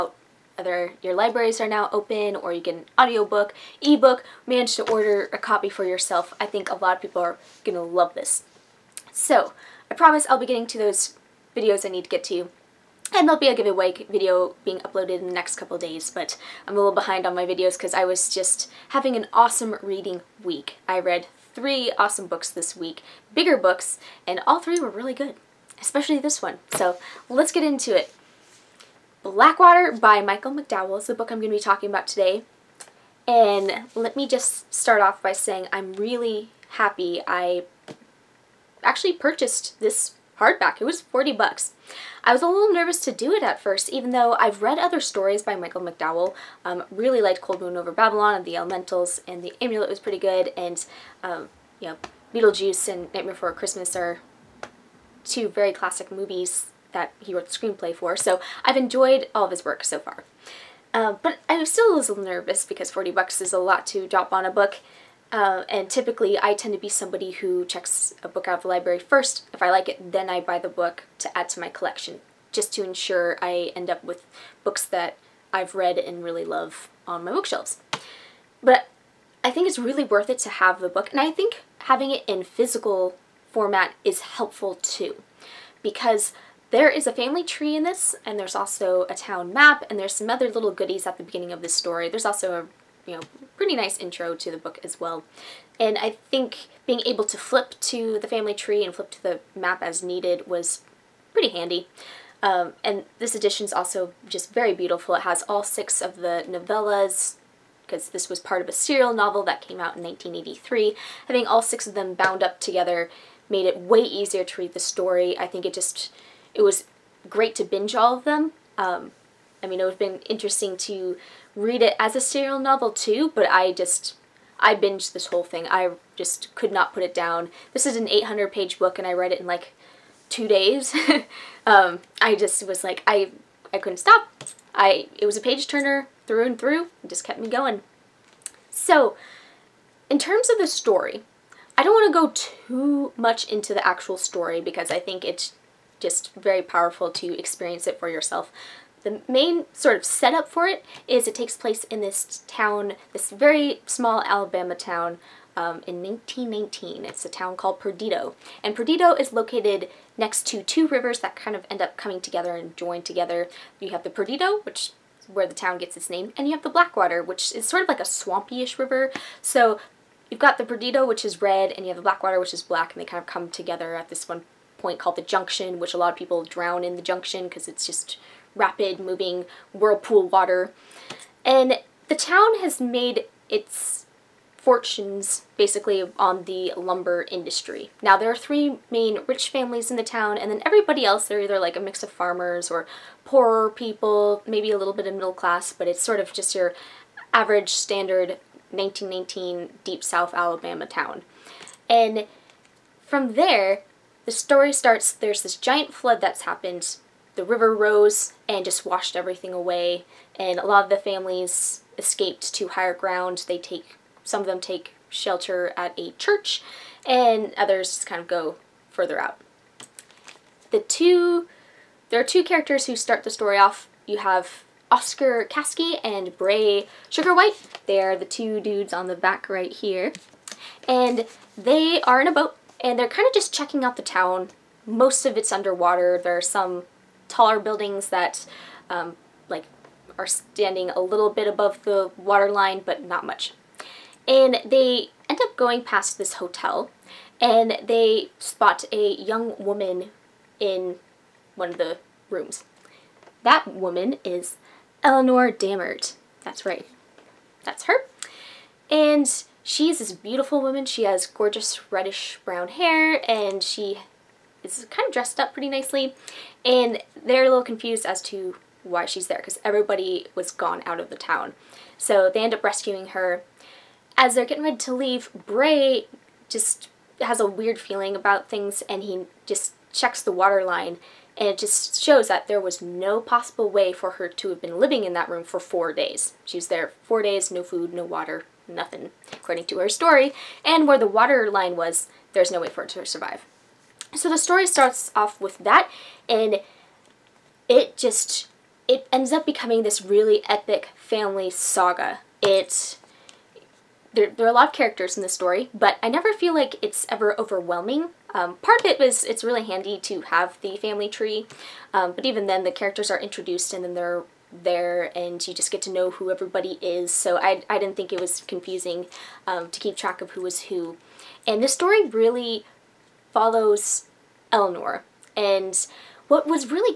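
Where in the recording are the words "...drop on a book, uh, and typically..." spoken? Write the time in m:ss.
1:04.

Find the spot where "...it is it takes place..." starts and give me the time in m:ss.
2:30.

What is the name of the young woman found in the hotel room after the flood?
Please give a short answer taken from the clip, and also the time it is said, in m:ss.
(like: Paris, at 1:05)
Elinor Dammert, at 4:15.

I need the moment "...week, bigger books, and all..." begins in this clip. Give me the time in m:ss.
0:22.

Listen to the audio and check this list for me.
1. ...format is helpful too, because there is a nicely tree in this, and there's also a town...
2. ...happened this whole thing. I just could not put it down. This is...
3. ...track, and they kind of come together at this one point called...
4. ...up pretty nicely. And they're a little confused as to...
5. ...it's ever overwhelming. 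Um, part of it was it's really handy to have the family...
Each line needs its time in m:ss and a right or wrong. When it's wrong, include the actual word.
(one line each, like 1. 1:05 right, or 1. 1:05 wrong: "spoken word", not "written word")
1. 1:23 wrong: "family", not "nicely"
2. 2:04 wrong: "binged", not "happened"
3. 2:52 wrong: "black", not "track"
4. 4:25 right
5. 5:06 right.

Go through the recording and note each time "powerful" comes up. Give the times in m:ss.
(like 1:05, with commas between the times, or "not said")
2:26.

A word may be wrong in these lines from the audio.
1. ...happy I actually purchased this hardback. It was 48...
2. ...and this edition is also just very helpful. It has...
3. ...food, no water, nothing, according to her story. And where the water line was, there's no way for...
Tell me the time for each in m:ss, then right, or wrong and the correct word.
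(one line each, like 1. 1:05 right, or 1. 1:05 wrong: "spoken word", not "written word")
1. 0:36 wrong: "40", not "48"
2. 1:42 wrong: "beautiful", not "helpful"
3. 4:47 right.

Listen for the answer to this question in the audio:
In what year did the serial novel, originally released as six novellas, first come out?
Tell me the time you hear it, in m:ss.
1:50.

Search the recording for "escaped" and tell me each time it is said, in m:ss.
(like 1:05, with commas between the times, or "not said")
3:31.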